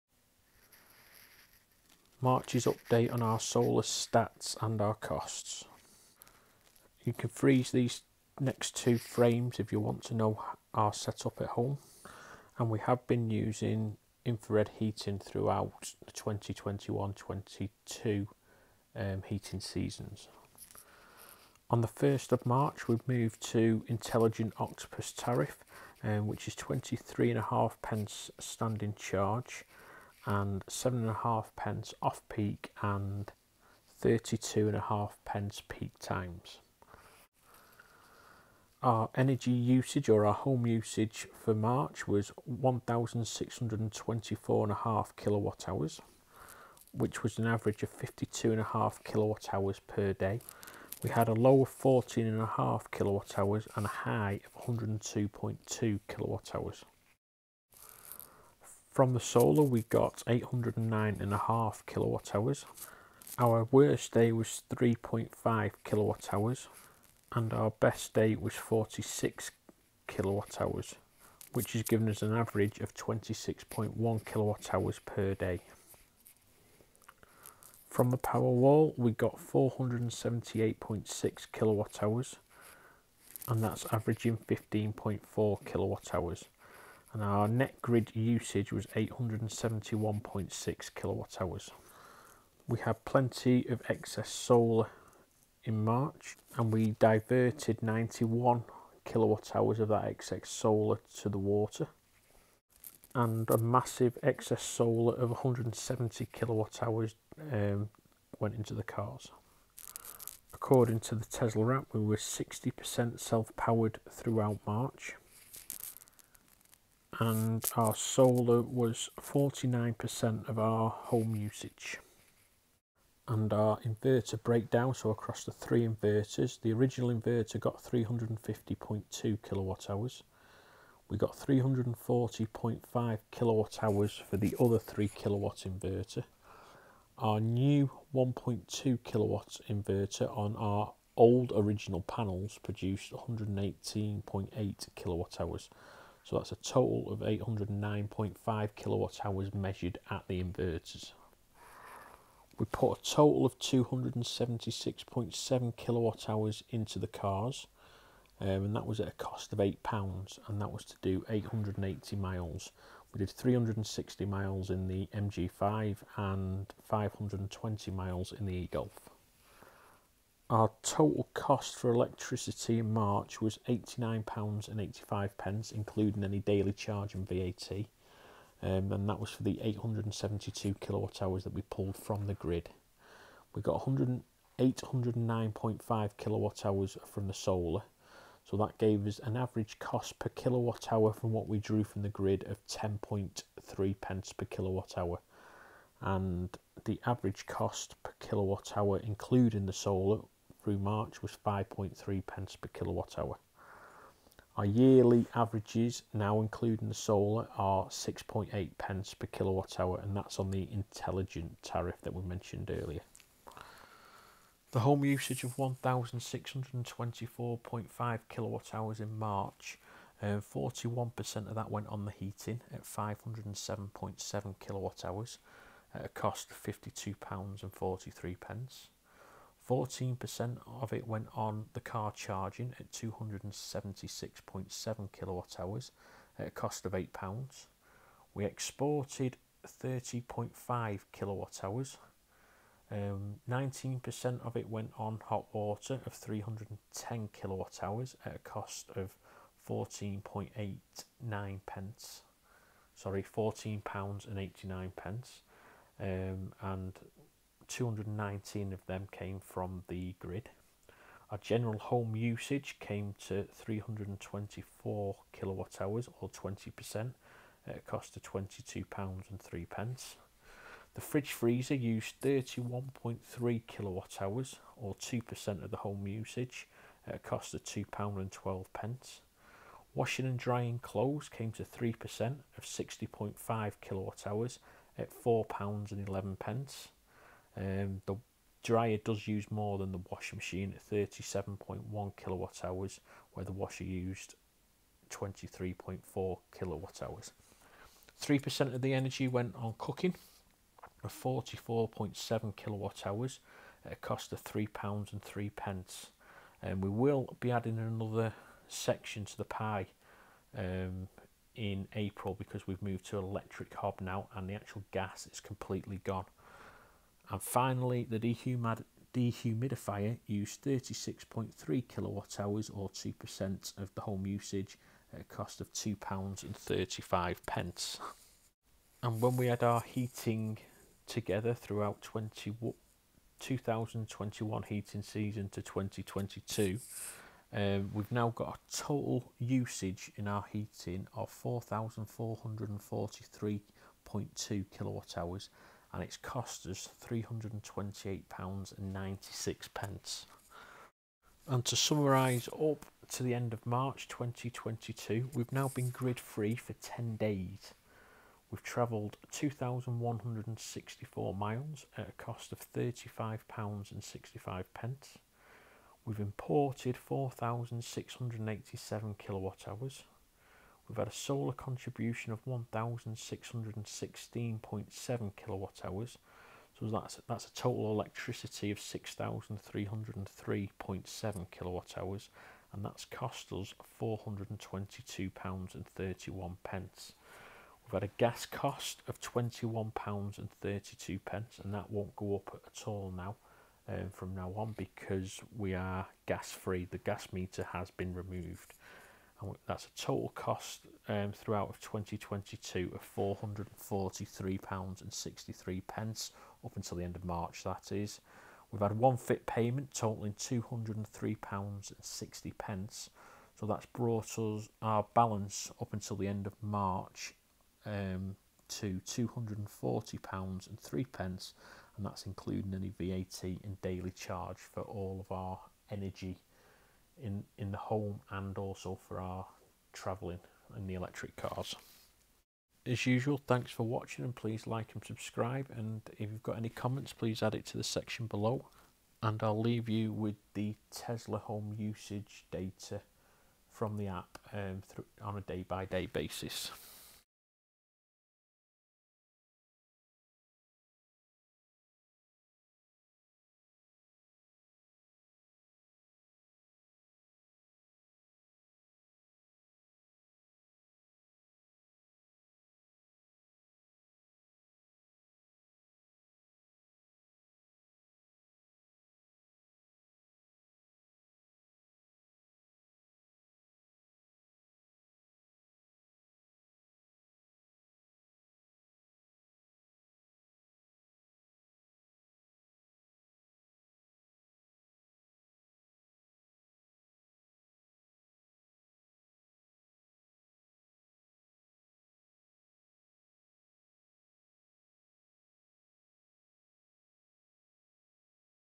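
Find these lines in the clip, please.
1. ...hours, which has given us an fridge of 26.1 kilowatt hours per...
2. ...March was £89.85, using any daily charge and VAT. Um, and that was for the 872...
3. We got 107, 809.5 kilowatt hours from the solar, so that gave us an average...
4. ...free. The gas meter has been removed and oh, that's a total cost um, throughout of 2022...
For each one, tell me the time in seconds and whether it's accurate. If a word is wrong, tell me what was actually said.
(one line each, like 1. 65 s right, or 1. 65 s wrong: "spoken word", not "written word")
1. 70 s wrong: "average", not "fridge"
2. 172 s wrong: "including", not "using"
3. 183 s wrong: "100", not "107"
4. 396 s right.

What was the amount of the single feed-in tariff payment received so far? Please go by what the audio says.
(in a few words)
£203.60.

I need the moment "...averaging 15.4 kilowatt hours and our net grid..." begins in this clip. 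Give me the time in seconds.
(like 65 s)
83 s.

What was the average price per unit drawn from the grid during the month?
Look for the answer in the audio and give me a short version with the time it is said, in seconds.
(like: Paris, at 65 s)
10.3 pence, at 192 s.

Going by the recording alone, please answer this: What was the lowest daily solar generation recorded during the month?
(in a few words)
3.5 kWh.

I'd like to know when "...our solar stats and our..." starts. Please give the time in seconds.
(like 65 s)
3 s.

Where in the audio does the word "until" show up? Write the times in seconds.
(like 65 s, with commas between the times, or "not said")
406 s, 415 s.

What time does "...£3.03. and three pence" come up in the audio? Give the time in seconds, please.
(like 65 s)
304 s.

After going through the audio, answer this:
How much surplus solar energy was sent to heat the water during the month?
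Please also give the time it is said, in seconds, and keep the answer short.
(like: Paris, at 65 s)
91 kWh, at 97 s.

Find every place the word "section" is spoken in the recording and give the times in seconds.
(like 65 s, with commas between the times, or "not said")
308 s, 437 s.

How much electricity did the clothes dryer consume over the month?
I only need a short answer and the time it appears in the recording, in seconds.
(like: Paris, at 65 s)
37.1 kWh, at 290 s.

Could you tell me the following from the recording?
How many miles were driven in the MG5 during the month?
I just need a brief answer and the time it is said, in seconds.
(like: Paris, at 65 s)
360 miles, at 163 s.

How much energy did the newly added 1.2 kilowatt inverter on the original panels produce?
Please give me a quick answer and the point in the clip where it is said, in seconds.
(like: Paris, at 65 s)
118.8 kWh, at 143 s.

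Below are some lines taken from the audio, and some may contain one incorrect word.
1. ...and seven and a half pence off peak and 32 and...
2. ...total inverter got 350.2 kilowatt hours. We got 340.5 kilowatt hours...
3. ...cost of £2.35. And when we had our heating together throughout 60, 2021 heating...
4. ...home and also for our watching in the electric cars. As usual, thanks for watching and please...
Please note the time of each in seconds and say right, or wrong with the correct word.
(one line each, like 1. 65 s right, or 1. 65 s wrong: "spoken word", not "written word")
1. 30 s right
2. 126 s wrong: "original", not "total"
3. 325 s wrong: "20", not "60"
4. 427 s wrong: "travelling", not "watching".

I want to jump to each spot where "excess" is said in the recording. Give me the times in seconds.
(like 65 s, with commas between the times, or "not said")
93 s, 100 s, 104 s.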